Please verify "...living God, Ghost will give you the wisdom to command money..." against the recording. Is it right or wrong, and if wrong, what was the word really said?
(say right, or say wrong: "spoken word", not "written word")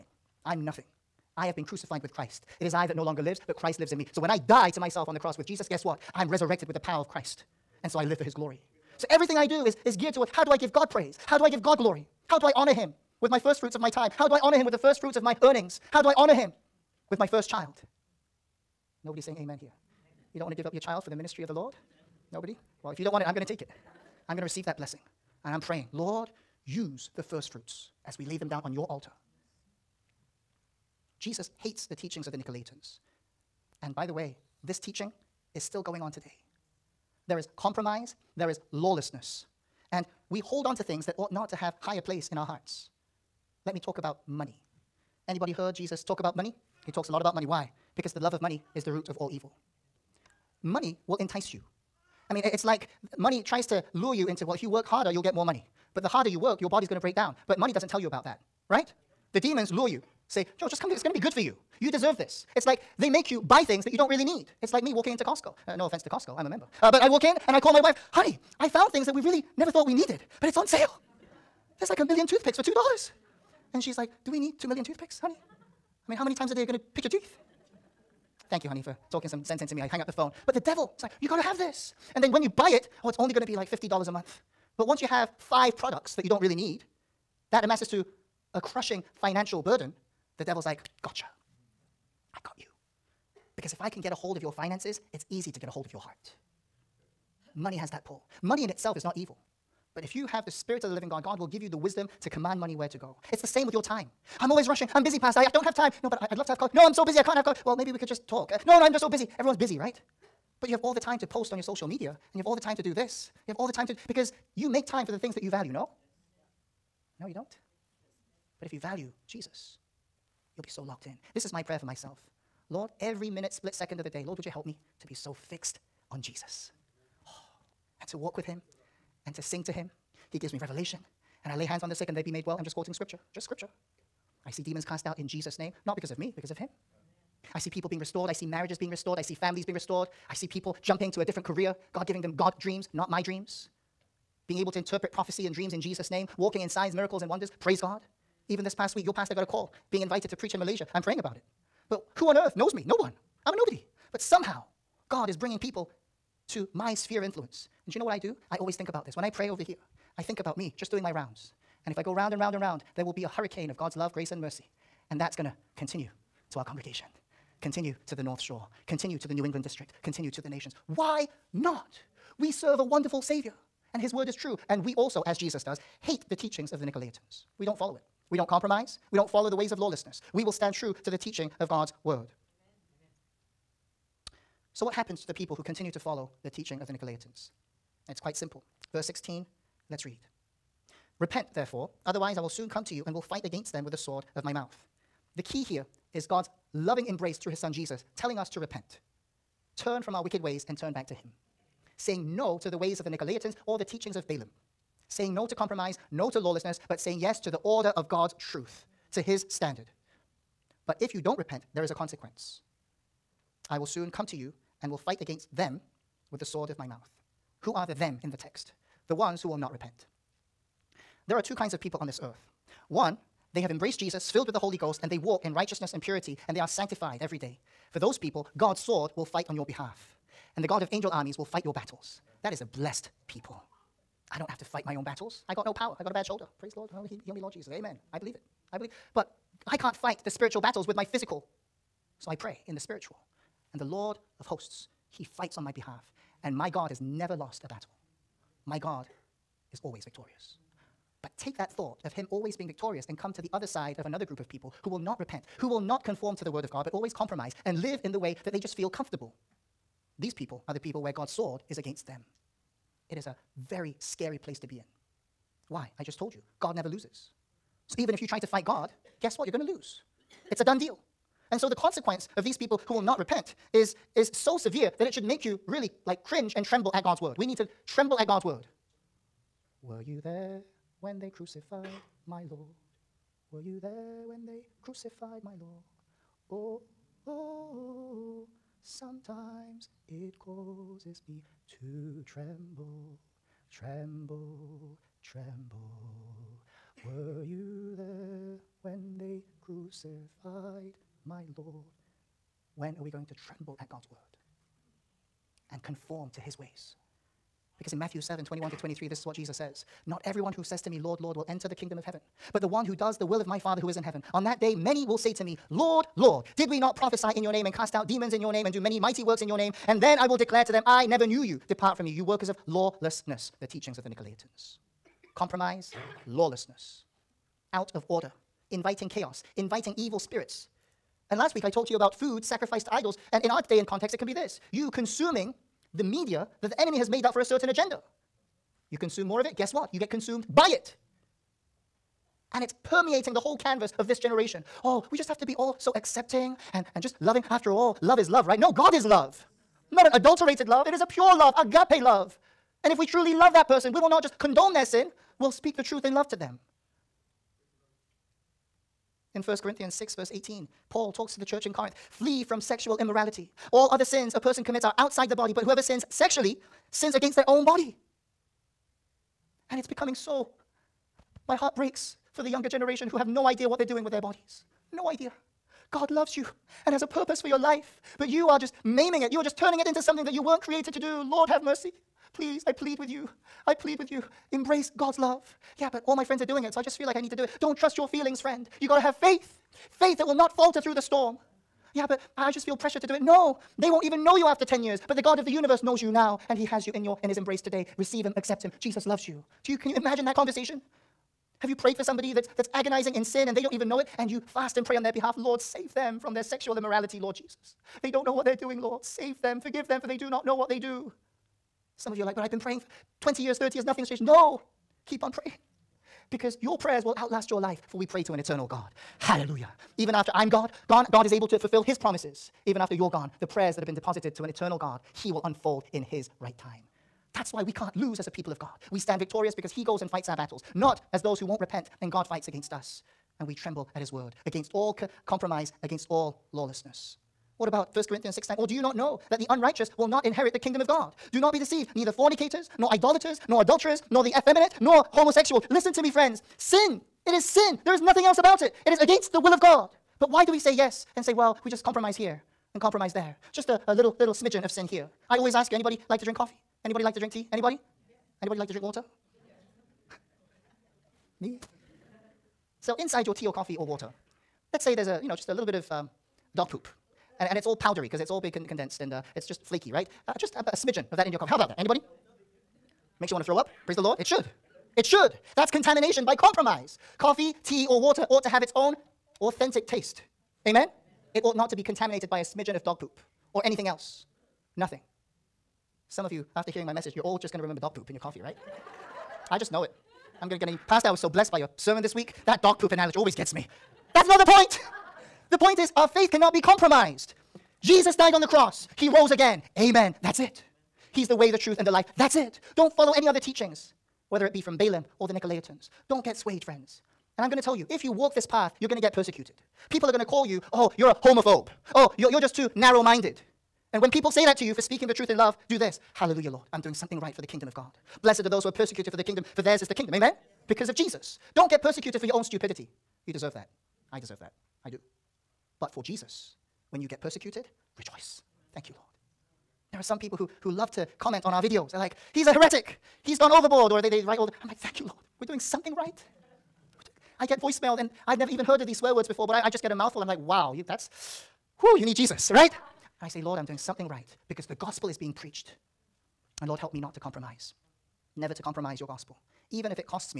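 wrong: "God", not "Ghost".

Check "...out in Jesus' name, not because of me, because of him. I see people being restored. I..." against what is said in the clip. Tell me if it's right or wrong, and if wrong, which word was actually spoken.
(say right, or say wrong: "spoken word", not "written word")
right.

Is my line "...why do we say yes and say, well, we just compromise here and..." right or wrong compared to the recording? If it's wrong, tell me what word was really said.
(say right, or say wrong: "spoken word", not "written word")
right.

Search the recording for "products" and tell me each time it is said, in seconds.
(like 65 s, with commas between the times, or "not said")
85 s.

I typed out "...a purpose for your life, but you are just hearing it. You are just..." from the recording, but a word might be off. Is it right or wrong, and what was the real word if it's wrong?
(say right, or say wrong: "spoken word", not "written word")
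wrong: "maiming", not "hearing".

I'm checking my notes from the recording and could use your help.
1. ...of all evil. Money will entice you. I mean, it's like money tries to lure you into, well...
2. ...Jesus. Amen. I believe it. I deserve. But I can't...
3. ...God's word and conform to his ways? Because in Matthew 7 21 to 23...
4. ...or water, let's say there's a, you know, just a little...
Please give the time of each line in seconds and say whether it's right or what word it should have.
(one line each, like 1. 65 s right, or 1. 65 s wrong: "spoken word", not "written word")
1. 49 s right
2. 237 s wrong: "believe", not "deserve"
3. 303 s right
4. 463 s right.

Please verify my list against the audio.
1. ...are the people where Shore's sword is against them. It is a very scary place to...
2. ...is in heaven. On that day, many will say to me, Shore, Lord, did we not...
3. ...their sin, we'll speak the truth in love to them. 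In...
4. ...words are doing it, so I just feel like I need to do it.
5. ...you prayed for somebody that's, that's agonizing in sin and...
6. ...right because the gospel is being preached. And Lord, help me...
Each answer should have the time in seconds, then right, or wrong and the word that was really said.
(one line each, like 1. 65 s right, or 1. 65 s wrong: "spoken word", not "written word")
1. 260 s wrong: "God", not "Shore"
2. 313 s wrong: "Lord", not "Shore"
3. 354 s right
4. 386 s wrong: "friends", not "words"
5. 401 s right
6. 544 s right.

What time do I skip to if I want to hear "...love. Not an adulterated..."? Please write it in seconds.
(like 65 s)
349 s.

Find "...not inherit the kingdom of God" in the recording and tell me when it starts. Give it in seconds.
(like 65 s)
440 s.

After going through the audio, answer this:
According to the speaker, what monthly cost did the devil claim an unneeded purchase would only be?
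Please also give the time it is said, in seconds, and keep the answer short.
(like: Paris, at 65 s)
$50, at 83 s.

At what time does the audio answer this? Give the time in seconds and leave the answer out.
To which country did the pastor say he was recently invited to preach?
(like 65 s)
150 s.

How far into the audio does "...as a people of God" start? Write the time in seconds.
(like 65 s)
428 s.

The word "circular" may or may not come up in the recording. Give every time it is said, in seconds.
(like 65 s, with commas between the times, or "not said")
not said.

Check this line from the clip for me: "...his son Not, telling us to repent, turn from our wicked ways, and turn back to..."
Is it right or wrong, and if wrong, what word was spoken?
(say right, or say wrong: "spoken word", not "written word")
wrong: "Jesus", not "Not".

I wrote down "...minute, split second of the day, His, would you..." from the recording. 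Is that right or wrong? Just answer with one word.
wrong.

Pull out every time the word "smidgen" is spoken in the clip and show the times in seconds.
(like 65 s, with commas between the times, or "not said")
454 s, 470 s, 482 s.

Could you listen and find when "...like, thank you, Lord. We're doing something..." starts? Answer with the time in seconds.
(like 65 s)
534 s.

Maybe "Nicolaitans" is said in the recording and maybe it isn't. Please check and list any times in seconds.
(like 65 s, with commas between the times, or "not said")
32 s, 176 s, 186 s, 203 s, 324 s, 505 s.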